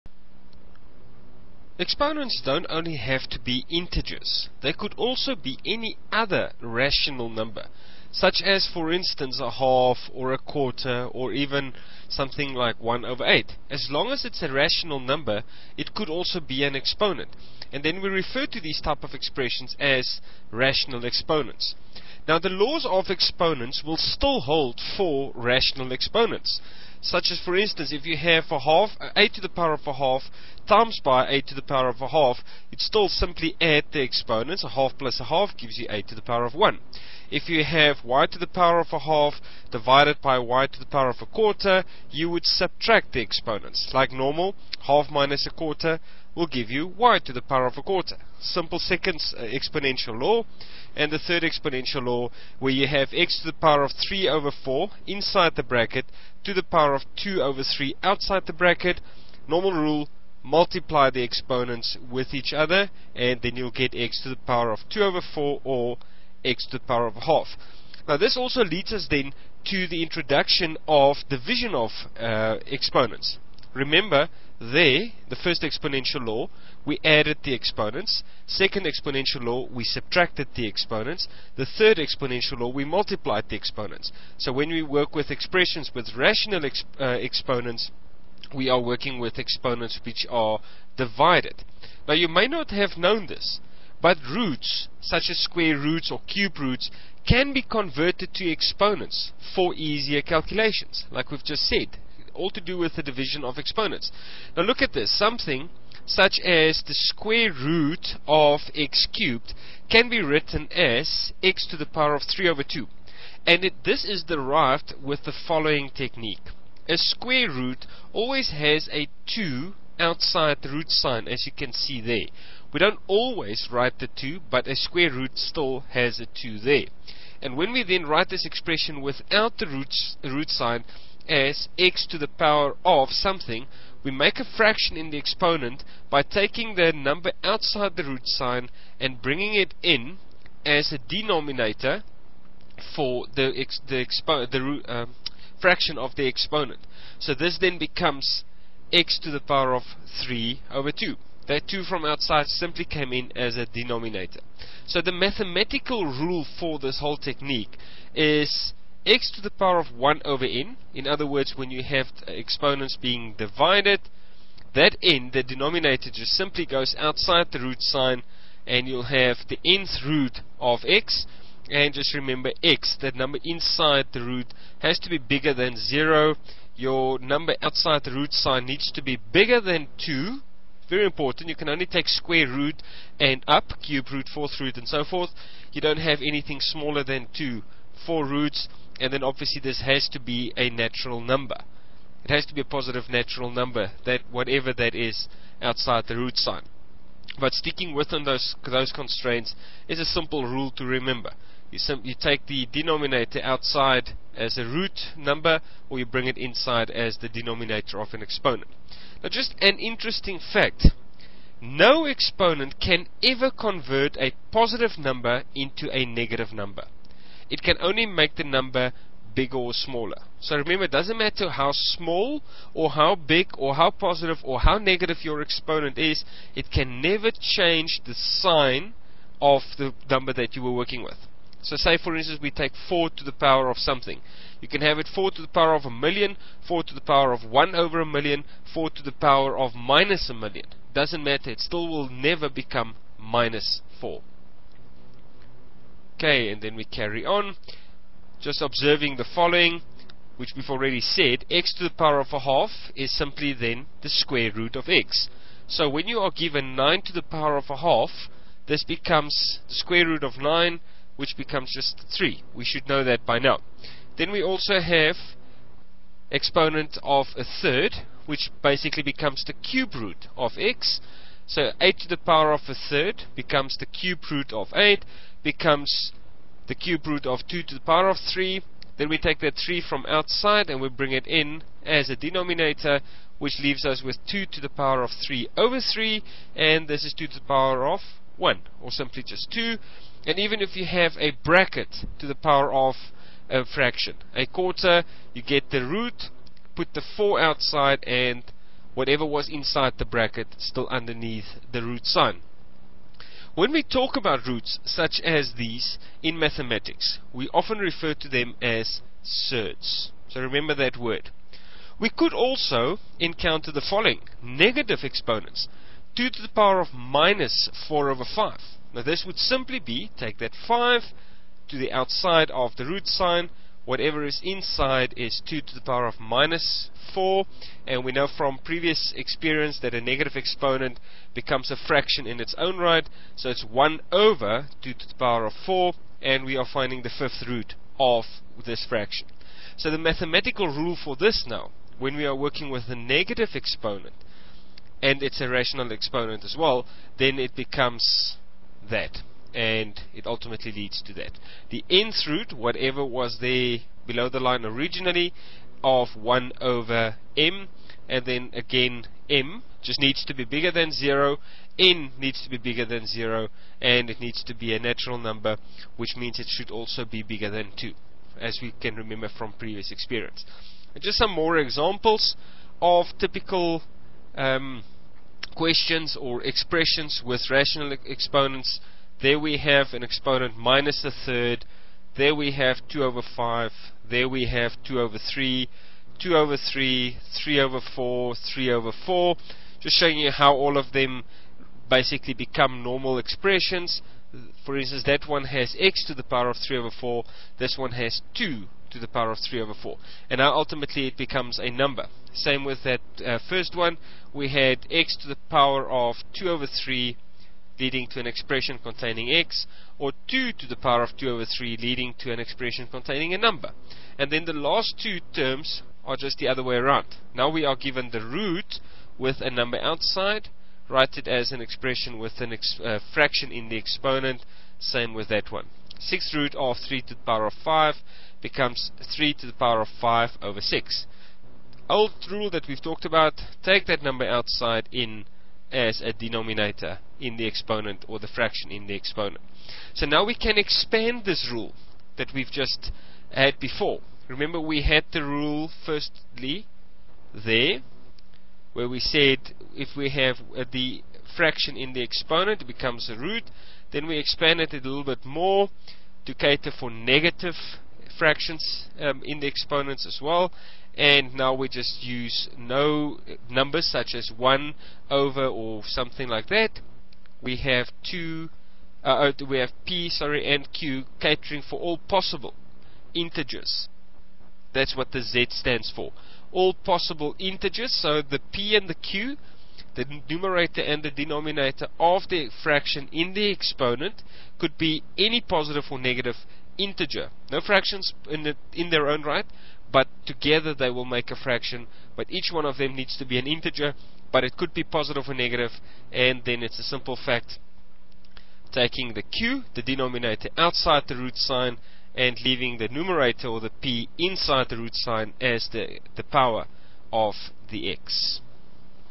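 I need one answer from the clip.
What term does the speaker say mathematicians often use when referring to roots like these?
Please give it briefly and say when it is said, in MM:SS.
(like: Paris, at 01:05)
surds, at 05:09.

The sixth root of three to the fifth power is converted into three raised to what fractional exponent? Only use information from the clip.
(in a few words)
5 over 6.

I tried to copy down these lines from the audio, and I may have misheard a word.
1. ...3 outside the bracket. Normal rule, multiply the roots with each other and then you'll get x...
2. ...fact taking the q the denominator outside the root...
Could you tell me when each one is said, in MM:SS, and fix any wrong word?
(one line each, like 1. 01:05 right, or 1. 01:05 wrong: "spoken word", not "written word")
1. 00:57 wrong: "exponents", not "roots"
2. 08:17 right.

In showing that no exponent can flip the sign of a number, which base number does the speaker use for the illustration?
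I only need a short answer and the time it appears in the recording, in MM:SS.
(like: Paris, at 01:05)
4, at 03:52.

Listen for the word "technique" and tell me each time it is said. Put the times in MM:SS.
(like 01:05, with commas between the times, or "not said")
01:55, 02:37.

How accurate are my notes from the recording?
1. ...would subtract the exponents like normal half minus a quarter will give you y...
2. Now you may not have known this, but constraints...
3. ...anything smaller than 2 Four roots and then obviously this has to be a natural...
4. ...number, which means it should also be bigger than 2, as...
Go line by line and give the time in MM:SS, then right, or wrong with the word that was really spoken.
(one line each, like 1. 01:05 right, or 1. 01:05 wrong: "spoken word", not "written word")
1. 00:42 right
2. 01:32 wrong: "roots", not "constraints"
3. 03:06 right
4. 06:05 right.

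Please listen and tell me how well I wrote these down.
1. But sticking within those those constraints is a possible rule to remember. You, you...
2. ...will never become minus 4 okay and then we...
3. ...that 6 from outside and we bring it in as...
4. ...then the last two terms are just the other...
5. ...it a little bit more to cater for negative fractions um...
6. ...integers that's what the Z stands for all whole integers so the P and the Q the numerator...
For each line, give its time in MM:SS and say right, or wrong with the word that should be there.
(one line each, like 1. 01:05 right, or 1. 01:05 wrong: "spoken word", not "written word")
1. 03:17 wrong: "simple", not "possible"
2. 04:01 right
3. 04:39 wrong: "3", not "6"
4. 06:54 right
5. 07:34 right
6. 07:53 wrong: "possible", not "whole".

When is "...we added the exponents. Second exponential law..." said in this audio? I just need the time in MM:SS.
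01:16.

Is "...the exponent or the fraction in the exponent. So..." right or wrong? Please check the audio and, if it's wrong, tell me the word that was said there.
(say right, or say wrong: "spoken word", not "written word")
right.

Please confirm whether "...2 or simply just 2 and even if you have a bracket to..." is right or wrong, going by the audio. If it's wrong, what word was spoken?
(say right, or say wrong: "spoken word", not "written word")
wrong: "1", not "2".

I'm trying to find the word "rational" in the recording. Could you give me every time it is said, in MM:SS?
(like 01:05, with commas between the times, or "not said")
00:06, 00:14, 00:20, 00:25, 01:26, 05:45, 06:17.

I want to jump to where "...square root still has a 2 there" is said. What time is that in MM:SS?
02:04.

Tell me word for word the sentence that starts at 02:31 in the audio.
That 2 from outside simply came in as a denominator.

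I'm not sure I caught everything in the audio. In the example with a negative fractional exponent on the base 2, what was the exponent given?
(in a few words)
minus 4 over 5.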